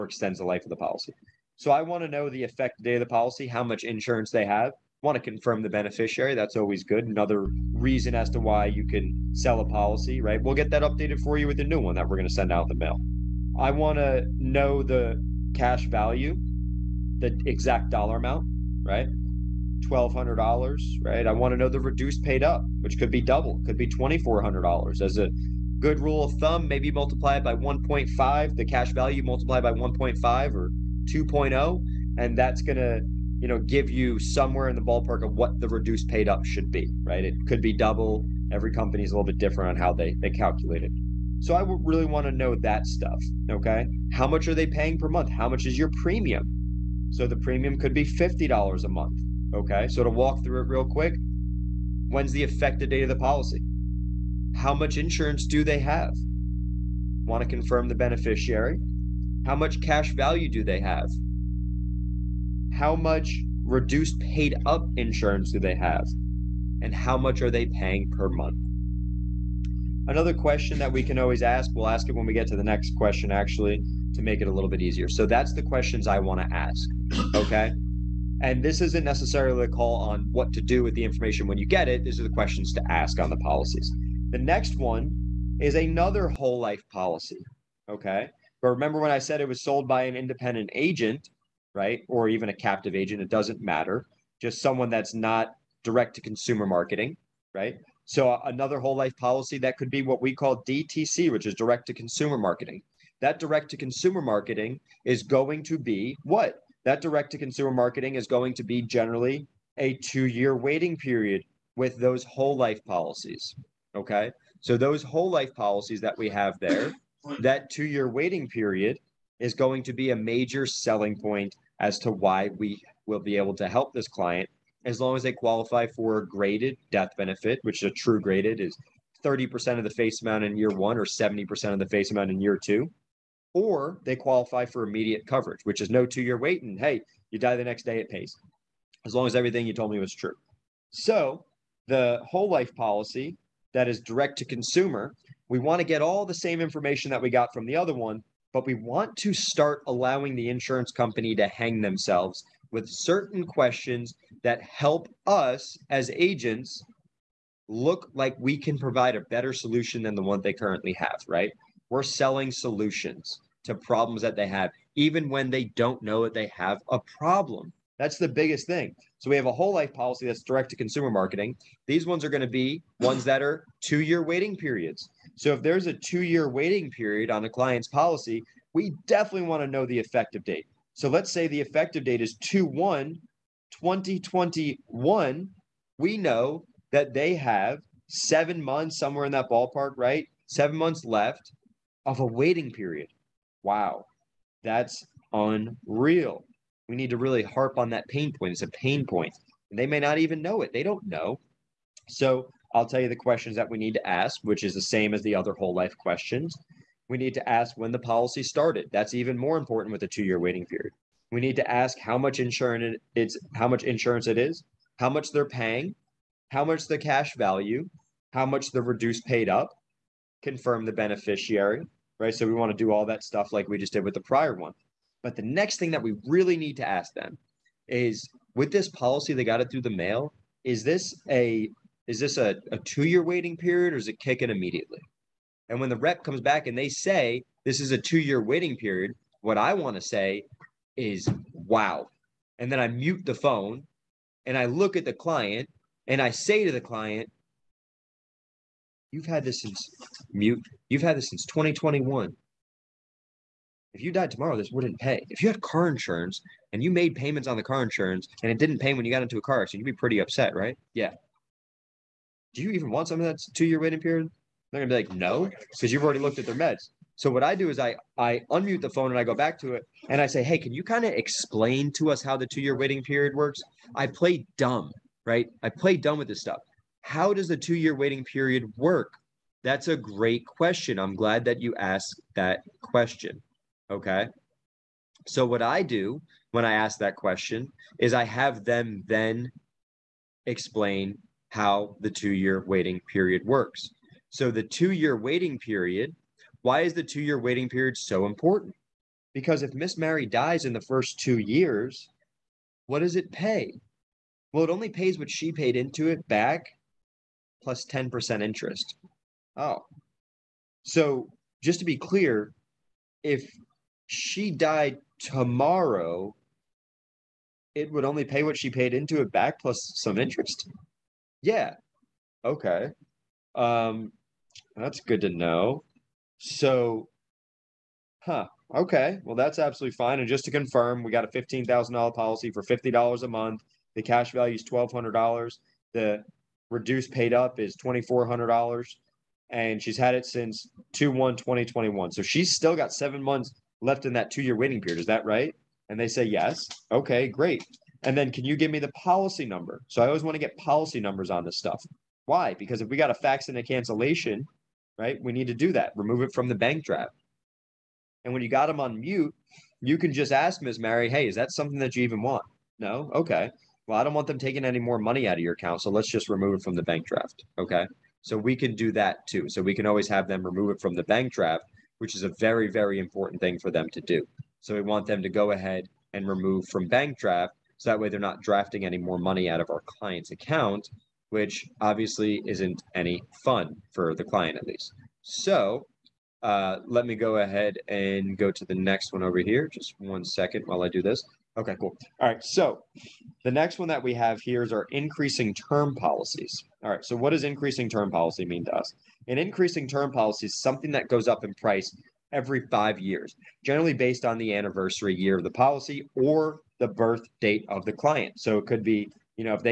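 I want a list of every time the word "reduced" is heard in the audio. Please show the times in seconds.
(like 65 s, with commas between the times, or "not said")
21 s, 35 s, 63 s, 218 s, 336 s.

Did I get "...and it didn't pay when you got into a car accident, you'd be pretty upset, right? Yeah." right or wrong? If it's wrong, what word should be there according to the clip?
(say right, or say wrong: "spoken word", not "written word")
right.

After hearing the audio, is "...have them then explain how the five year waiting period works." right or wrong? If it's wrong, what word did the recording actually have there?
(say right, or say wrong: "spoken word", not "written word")
wrong: "two", not "five".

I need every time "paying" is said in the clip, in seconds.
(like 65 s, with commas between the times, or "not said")
44 s, 67 s, 215 s.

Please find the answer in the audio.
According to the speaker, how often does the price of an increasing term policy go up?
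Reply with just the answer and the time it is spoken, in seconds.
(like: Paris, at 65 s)
Every 5 years, at 402 s.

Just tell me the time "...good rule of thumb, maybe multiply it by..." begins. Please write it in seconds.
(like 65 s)
25 s.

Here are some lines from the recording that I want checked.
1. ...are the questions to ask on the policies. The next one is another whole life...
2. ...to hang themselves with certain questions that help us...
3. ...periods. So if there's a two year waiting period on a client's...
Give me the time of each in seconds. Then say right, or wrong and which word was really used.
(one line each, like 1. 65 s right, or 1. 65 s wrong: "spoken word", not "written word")
1. 82 s right
2. 151 s right
3. 174 s right.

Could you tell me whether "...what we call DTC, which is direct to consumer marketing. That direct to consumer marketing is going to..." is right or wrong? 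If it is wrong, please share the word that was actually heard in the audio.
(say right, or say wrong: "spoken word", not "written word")
right.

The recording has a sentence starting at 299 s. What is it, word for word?
Because if Miss Mary dies in the first two years, what does it pay?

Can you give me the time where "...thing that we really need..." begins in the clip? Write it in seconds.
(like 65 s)
225 s.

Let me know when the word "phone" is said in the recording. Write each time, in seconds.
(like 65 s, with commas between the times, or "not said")
243 s, 268 s.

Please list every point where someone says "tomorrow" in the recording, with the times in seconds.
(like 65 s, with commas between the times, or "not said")
254 s, 315 s.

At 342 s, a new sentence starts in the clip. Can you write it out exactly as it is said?
So she's still got seven months left in that two year waiting period.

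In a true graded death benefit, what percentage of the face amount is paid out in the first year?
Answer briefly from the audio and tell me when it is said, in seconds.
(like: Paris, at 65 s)
30%, at 129 s.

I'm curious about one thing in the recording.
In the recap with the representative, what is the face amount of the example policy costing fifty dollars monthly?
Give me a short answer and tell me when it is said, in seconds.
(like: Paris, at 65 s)
$15,000, at 331 s.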